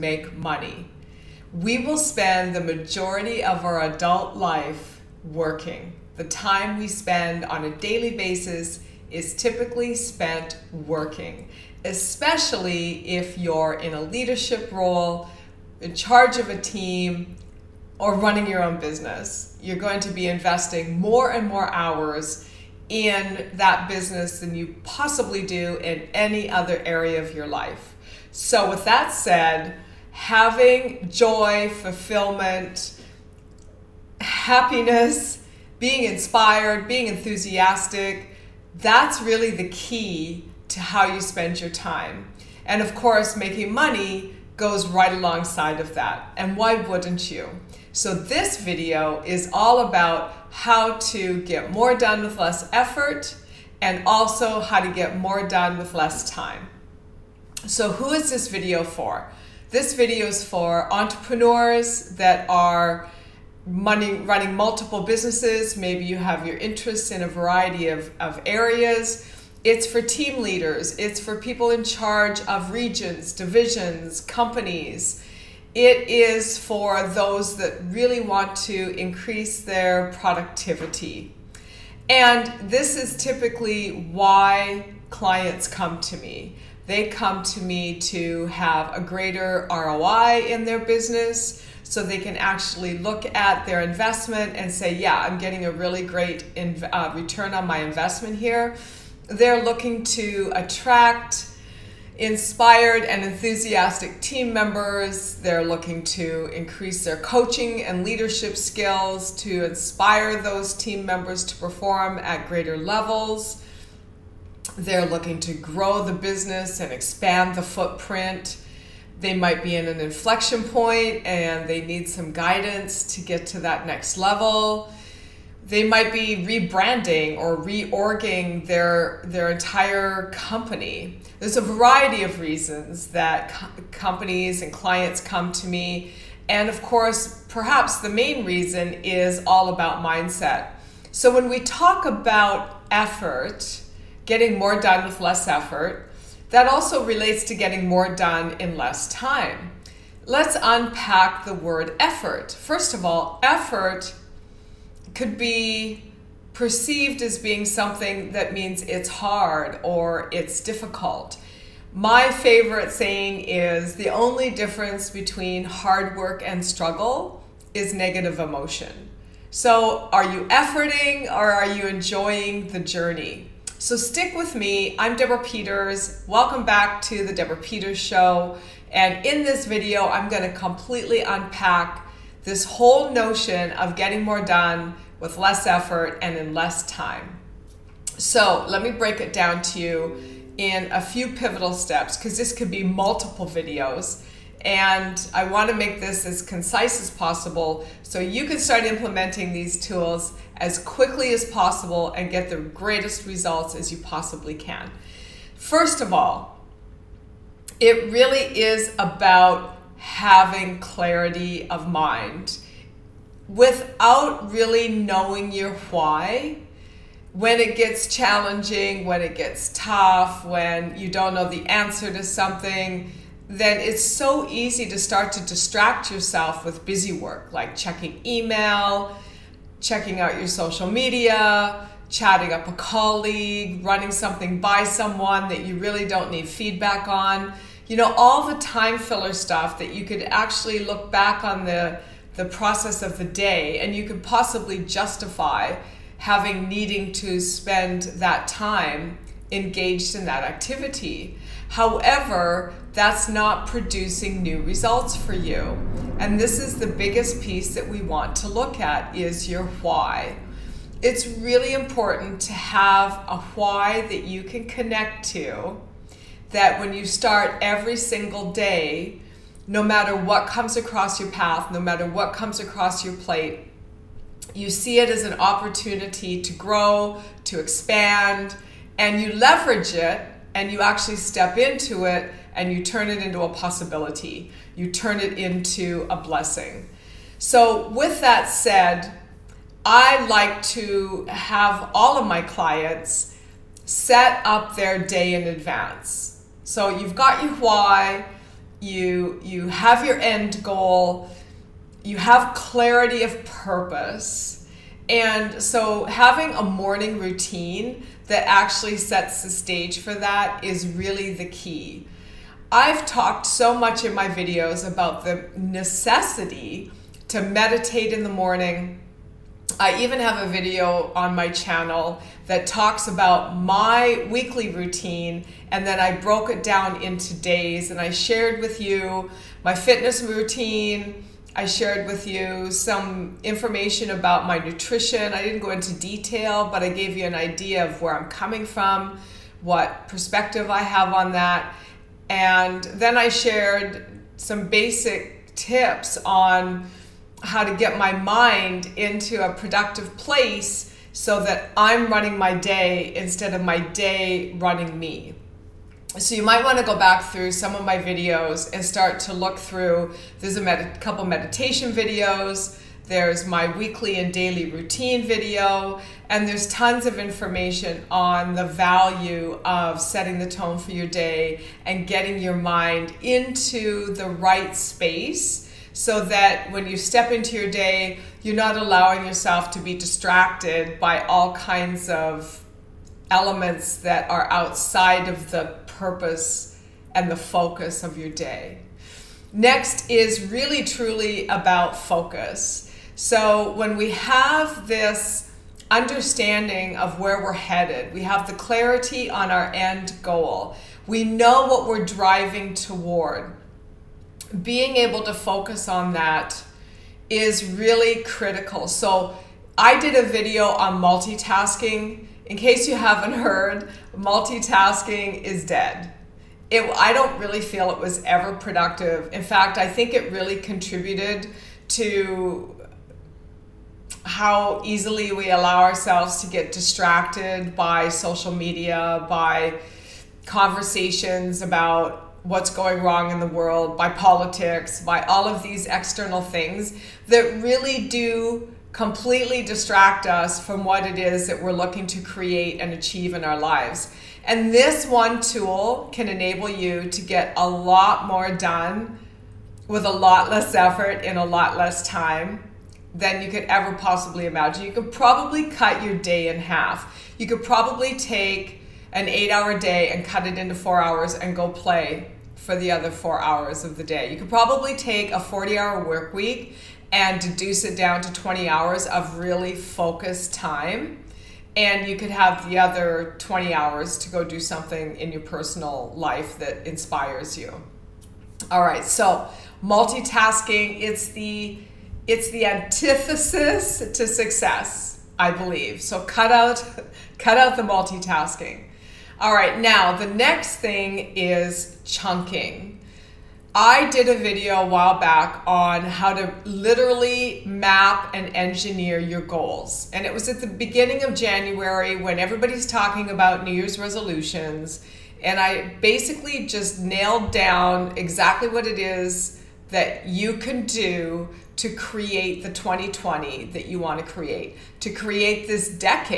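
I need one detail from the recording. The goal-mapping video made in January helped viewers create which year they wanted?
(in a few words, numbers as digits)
2020.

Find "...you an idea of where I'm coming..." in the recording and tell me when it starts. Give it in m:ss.
5:37.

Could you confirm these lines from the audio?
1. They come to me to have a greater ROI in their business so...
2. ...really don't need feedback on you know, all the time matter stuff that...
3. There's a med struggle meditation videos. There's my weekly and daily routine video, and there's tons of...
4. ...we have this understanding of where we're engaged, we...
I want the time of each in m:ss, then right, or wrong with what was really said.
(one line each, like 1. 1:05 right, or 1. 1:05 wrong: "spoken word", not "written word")
1. 1:26 right
2. 3:55 wrong: "filler", not "matter"
3. 6:00 wrong: "couple", not "struggle"
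4. 6:33 wrong: "headed", not "engaged".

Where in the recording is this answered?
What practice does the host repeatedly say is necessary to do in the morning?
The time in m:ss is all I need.
5:17.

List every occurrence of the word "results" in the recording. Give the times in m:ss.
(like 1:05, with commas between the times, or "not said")
3:23, 4:14.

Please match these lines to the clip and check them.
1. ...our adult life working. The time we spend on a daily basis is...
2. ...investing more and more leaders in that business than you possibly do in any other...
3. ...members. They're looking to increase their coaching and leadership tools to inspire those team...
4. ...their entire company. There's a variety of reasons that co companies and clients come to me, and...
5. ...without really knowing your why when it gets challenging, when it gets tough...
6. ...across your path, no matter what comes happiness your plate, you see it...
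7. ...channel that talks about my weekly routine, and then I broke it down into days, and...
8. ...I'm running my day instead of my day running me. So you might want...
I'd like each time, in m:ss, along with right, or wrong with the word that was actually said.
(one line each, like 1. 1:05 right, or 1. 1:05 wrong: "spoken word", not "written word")
1. 0:03 right
2. 0:20 wrong: "hours", not "leaders"
3. 1:44 wrong: "skills", not "tools"
4. 2:09 right
5. 3:33 right
6. 4:30 wrong: "across", not "happiness"
7. 5:21 right
8. 5:51 right.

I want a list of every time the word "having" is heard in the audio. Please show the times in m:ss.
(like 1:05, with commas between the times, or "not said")
0:30, 3:30, 4:06, 5:06.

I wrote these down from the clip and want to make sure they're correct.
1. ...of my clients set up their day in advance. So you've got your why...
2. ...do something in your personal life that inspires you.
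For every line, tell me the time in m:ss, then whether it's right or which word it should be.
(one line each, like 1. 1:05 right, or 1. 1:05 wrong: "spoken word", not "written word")
1. 4:52 right
2. 7:54 right.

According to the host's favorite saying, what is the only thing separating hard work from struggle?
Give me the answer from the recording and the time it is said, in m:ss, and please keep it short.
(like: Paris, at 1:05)
Negative emotion, at 2:47.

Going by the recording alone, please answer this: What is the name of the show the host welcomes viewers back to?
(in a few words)
The Deborah Peters Show.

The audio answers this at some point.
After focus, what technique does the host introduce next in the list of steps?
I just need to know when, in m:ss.
8:12.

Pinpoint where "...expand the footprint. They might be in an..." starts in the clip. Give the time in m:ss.
1:56.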